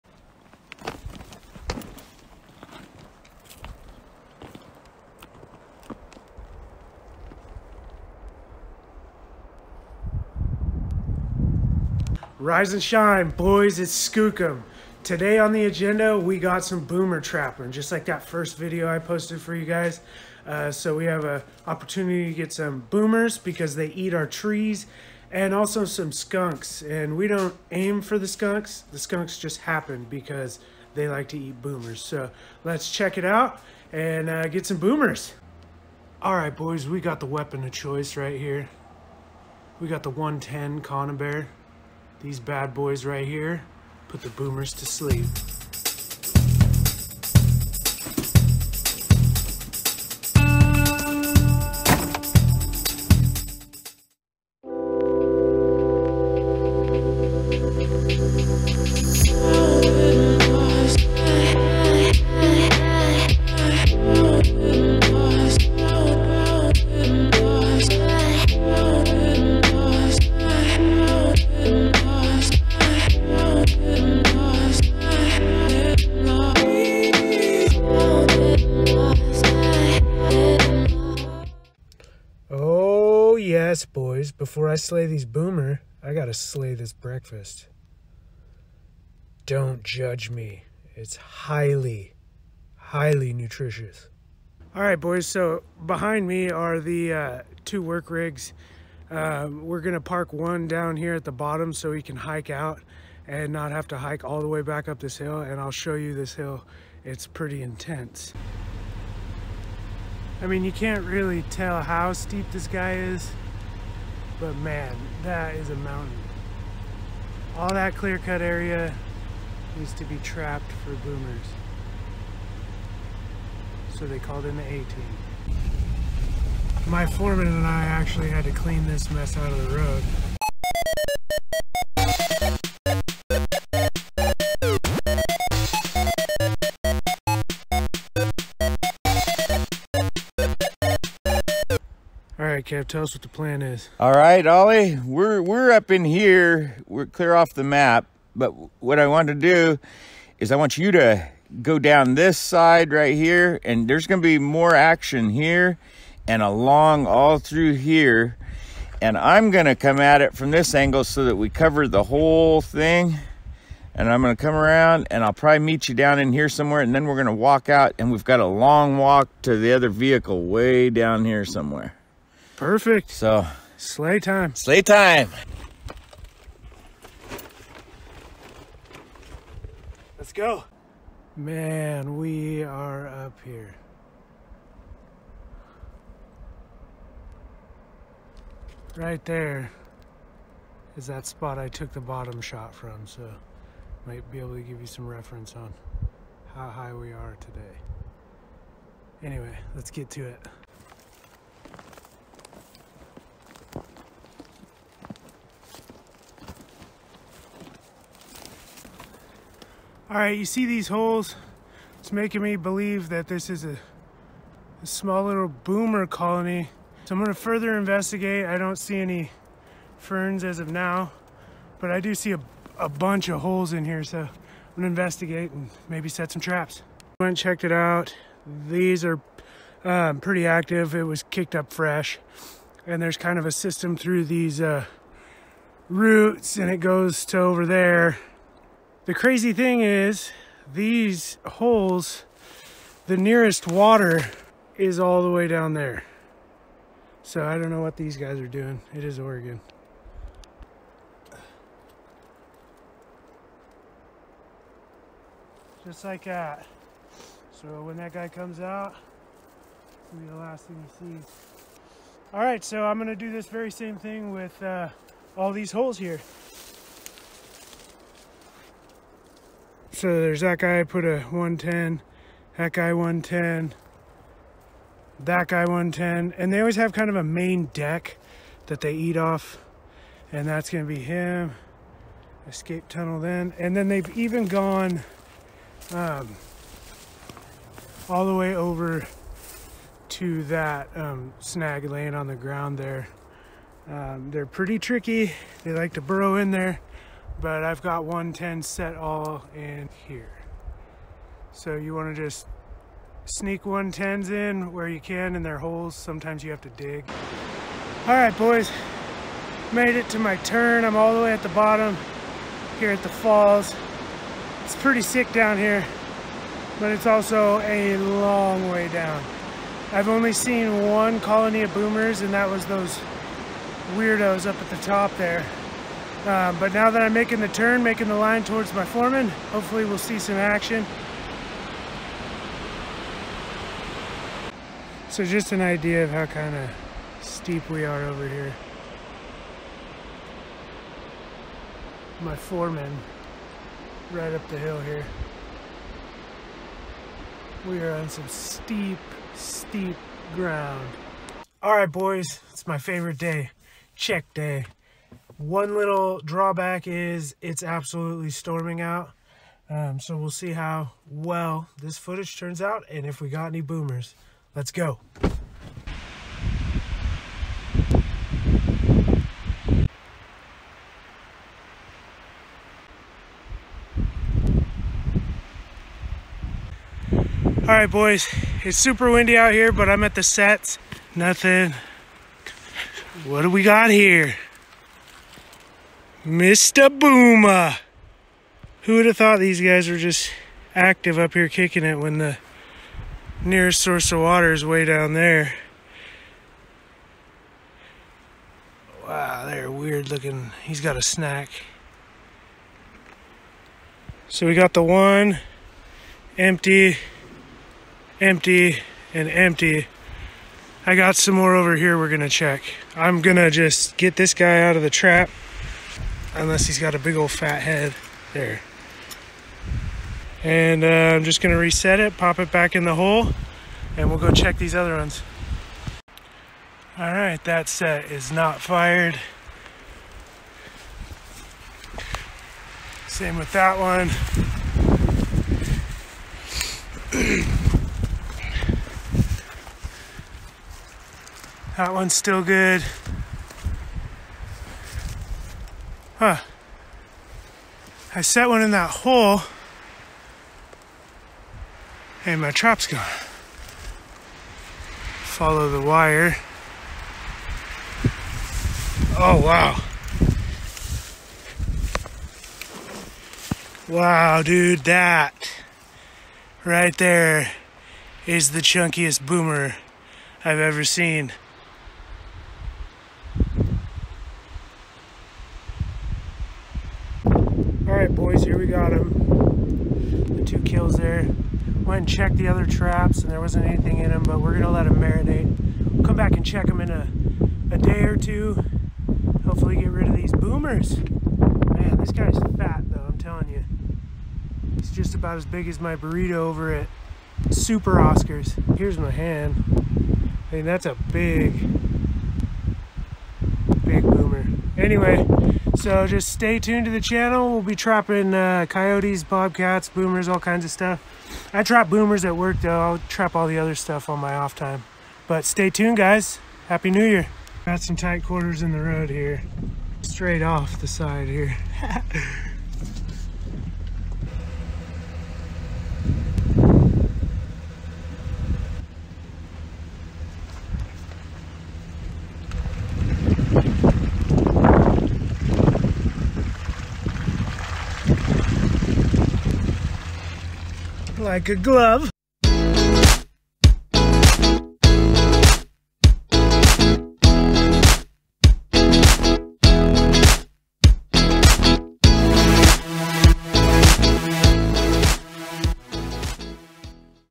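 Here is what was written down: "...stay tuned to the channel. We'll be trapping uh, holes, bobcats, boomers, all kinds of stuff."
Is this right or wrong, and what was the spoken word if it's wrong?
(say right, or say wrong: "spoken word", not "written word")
wrong: "coyotes", not "holes".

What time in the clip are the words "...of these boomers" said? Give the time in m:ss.
8:10.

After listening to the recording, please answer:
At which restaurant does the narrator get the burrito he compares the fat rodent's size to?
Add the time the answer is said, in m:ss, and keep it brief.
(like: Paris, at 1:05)
Super Oscars, at 8:17.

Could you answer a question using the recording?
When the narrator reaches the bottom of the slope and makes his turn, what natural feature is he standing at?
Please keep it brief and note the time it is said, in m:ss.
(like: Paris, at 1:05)
The falls, at 5:13.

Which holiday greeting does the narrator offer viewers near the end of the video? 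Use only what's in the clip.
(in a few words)
Happy New Year.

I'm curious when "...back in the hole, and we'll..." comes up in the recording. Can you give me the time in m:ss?
7:02.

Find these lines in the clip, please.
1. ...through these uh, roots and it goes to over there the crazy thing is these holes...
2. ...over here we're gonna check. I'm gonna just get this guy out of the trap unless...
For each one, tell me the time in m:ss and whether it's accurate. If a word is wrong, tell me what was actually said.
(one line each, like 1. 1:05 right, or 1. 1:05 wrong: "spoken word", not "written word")
1. 3:53 right
2. 6:51 right.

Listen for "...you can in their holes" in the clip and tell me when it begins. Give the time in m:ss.
5:04.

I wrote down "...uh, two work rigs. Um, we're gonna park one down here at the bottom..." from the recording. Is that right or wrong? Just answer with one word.
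right.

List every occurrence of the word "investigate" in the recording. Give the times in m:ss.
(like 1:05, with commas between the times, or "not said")
3:37, 3:44.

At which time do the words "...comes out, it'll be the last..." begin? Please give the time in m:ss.
4:18.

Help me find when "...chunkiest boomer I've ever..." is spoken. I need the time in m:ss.
7:48.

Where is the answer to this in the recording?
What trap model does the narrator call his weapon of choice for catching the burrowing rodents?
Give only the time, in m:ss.
0:40.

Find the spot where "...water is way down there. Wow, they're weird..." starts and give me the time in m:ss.
6:34.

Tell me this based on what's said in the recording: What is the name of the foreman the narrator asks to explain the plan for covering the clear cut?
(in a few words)
Kev.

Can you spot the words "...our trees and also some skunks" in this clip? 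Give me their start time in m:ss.
0:24.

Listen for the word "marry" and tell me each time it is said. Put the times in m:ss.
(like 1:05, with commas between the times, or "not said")
not said.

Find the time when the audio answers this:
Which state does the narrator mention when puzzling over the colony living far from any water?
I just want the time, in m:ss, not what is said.
4:09.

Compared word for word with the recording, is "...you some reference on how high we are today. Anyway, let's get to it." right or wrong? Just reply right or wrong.
right.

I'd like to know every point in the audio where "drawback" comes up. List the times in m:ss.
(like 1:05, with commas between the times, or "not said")
5:56.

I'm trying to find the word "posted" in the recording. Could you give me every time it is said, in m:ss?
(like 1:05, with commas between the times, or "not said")
0:18.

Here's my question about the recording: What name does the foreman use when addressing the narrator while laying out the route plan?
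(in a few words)
Ollie.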